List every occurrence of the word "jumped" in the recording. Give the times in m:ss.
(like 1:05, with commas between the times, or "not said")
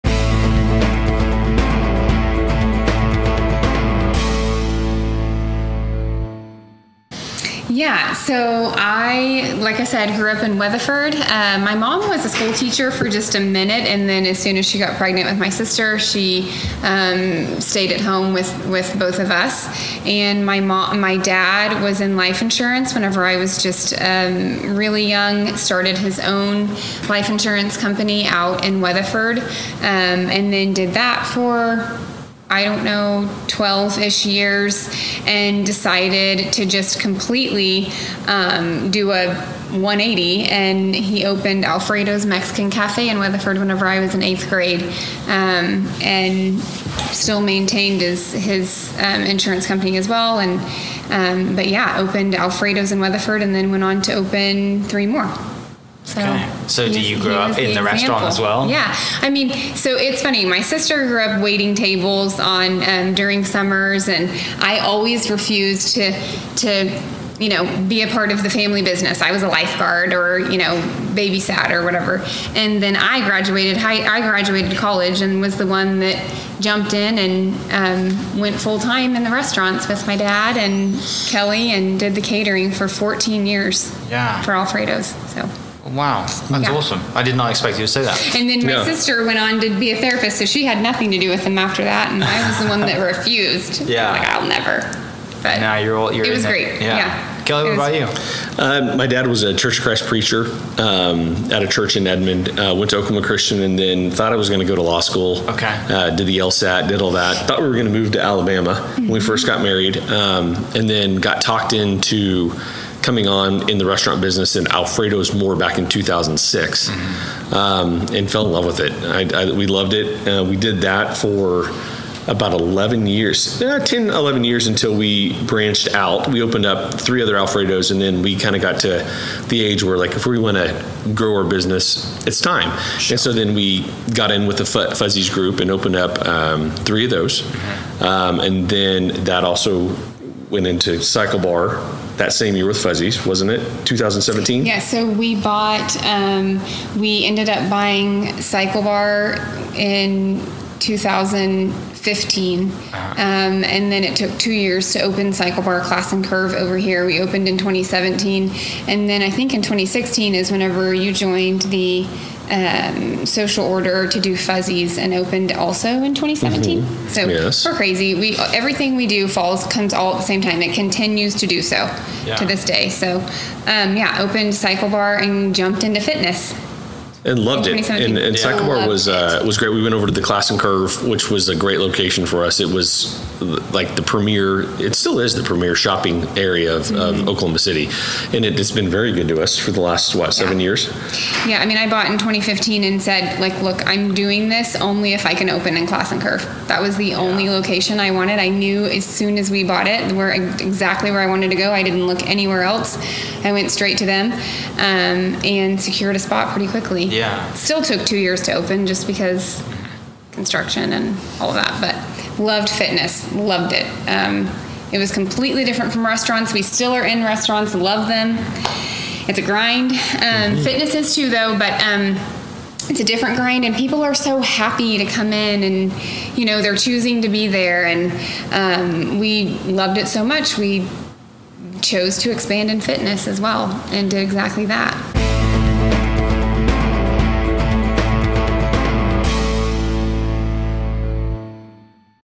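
1:16, 2:55.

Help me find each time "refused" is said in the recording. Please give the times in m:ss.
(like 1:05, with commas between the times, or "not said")
1:05, 1:33.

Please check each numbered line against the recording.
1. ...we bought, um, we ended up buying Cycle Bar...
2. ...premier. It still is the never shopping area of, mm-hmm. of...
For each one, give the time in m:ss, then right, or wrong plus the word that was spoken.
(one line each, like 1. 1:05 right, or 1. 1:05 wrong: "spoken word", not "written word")
1. 2:25 right
2. 3:04 wrong: "premier", not "never".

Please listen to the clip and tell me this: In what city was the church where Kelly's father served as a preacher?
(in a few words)
Edmond.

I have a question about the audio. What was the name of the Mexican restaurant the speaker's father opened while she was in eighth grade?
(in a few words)
Alfredo's Mexican Cafe.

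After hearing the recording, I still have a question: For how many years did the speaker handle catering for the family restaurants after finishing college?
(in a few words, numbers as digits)
14.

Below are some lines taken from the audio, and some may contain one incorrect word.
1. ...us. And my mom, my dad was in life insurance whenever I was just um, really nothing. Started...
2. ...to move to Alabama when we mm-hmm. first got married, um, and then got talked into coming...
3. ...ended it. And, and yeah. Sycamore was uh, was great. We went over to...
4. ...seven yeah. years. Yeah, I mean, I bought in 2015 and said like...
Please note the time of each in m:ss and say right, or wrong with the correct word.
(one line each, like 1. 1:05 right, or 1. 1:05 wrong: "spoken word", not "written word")
1. 0:19 wrong: "young", not "nothing"
2. 1:47 right
3. 2:57 wrong: "loved", not "ended"
4. 3:10 right.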